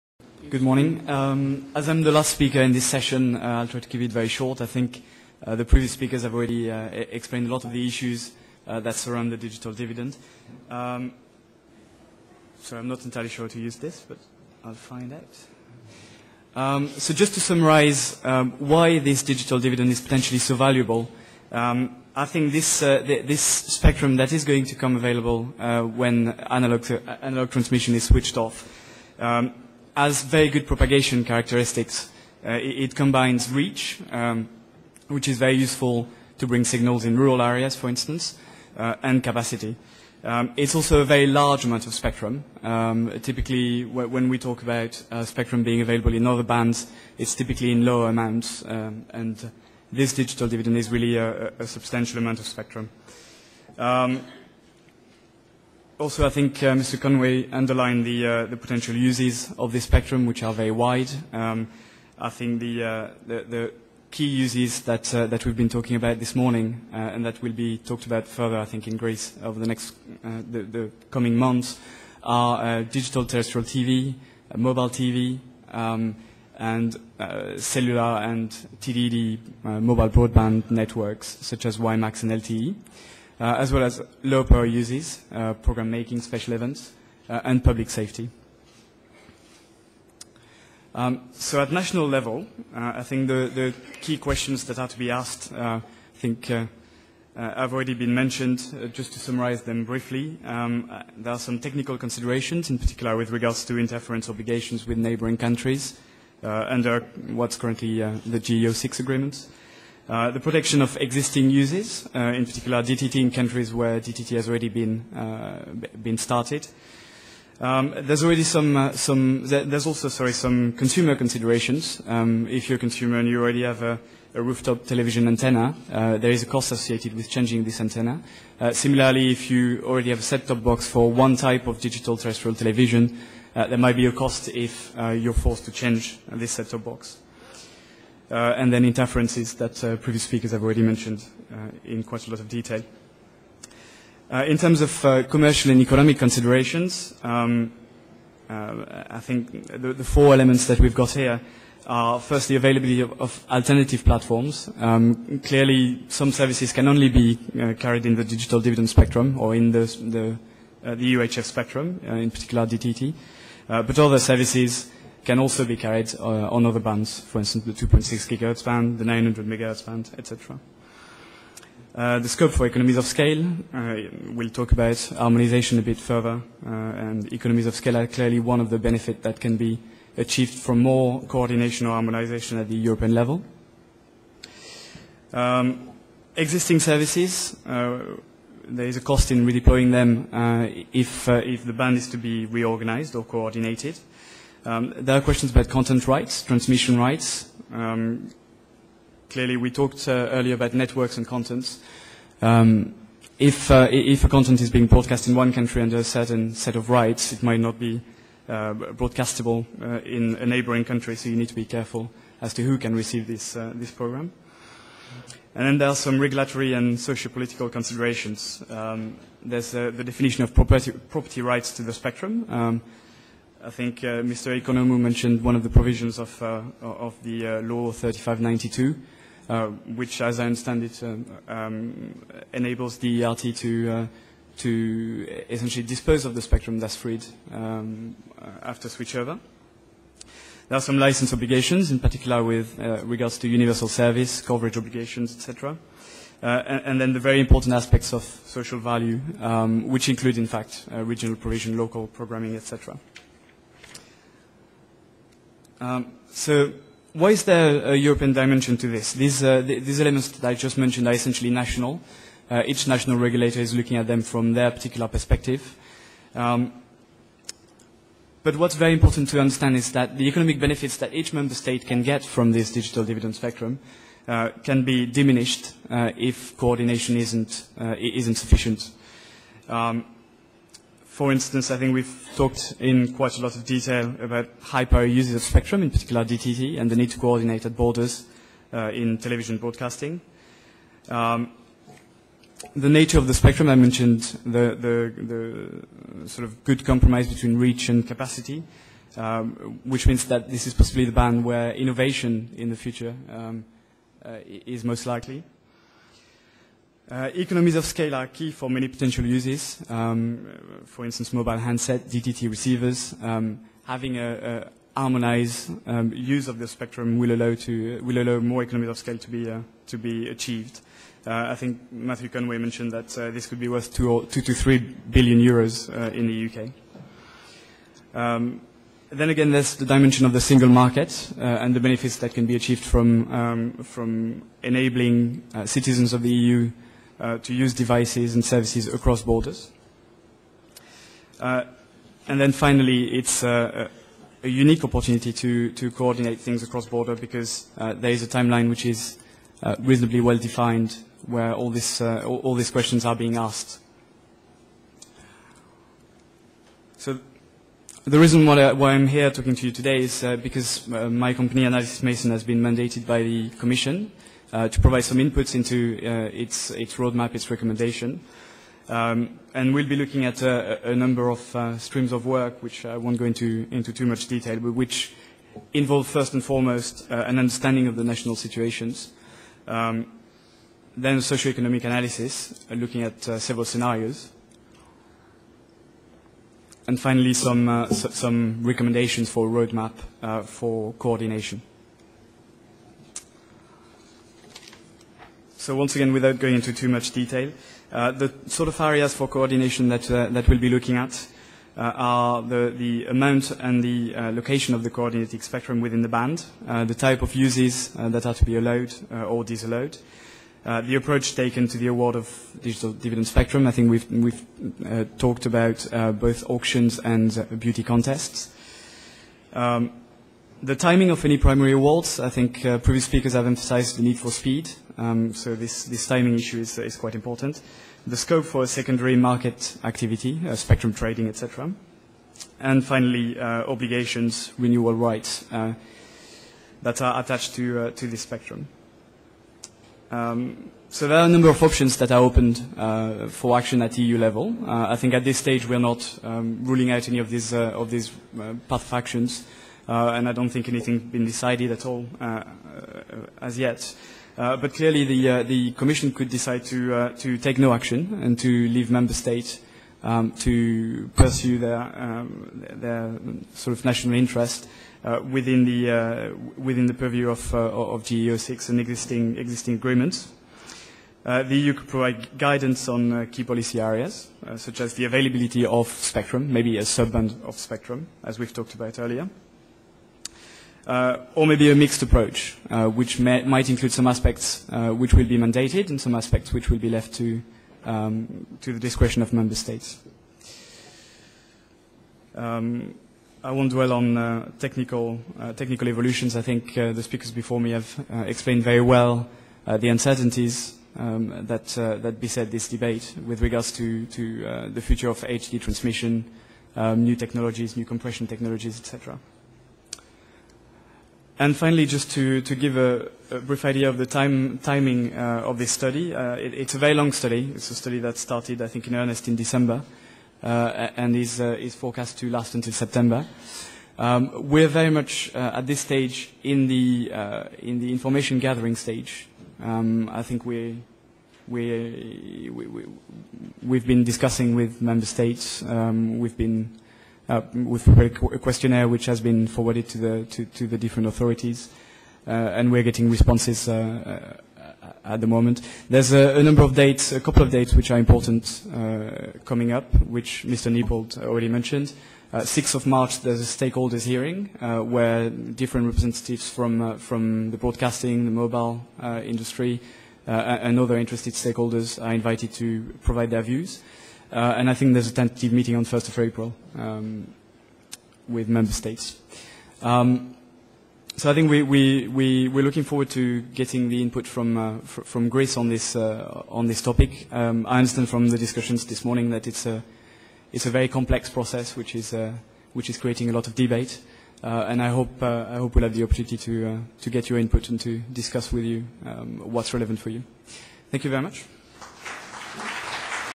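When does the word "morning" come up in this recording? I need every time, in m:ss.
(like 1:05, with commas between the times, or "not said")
0:00, 1:06, 9:39.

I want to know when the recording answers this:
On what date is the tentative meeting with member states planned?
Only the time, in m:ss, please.
9:25.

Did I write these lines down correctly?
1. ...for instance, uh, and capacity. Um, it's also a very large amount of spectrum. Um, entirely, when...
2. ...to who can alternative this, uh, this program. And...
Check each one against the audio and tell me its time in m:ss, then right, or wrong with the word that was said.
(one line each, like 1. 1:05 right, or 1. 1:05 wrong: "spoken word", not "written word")
1. 0:37 wrong: "typically", not "entirely"
2. 3:32 wrong: "receive", not "alternative".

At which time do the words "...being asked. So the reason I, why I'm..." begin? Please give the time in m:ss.
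5:53.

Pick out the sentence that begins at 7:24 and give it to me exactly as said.
I think at this stage we're not um, ruling out any of these, of these path of actions.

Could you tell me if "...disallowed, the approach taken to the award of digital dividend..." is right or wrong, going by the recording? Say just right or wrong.
right.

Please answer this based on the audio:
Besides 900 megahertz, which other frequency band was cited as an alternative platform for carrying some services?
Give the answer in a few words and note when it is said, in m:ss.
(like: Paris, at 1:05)
2.6 gigahertz, at 2:47.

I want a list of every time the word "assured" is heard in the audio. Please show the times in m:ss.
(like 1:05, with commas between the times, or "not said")
not said.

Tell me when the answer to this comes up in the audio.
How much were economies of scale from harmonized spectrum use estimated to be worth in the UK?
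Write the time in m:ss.
5:24.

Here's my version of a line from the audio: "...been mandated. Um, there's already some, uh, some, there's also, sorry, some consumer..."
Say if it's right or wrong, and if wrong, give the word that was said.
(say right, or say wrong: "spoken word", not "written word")
wrong: "started", not "mandated".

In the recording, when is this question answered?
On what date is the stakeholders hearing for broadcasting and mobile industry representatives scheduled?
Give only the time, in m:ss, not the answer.
9:12.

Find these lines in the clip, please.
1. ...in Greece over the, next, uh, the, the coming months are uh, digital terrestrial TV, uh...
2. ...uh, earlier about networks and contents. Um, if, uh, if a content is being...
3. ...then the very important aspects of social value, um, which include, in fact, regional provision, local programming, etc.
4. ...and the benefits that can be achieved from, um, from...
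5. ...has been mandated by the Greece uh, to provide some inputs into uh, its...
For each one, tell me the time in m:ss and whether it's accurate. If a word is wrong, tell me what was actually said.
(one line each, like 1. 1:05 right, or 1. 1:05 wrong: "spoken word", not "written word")
1. 1:08 right
2. 3:20 right
3. 4:07 right
4. 5:31 right
5. 6:02 wrong: "Commission", not "Greece".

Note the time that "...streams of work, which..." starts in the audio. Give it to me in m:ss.
6:11.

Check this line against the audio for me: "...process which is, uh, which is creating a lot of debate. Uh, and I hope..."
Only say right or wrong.
right.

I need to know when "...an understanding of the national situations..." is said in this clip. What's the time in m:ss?
6:17.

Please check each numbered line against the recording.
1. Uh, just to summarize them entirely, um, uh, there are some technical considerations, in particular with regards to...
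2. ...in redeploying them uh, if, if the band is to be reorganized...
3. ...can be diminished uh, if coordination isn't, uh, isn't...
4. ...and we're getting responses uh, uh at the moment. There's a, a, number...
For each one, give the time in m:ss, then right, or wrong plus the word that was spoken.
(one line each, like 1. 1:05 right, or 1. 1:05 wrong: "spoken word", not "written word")
1. 1:38 wrong: "briefly", not "entirely"
2. 3:09 right
3. 4:34 right
4. 9:02 right.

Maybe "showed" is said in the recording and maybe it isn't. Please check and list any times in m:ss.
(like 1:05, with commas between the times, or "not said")
not said.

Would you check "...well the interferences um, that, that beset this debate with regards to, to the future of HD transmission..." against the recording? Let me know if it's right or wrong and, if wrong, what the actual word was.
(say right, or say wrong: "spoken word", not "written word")
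wrong: "uncertainties", not "interferences".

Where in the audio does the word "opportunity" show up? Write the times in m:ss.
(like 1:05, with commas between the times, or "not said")
5:44, 9:46.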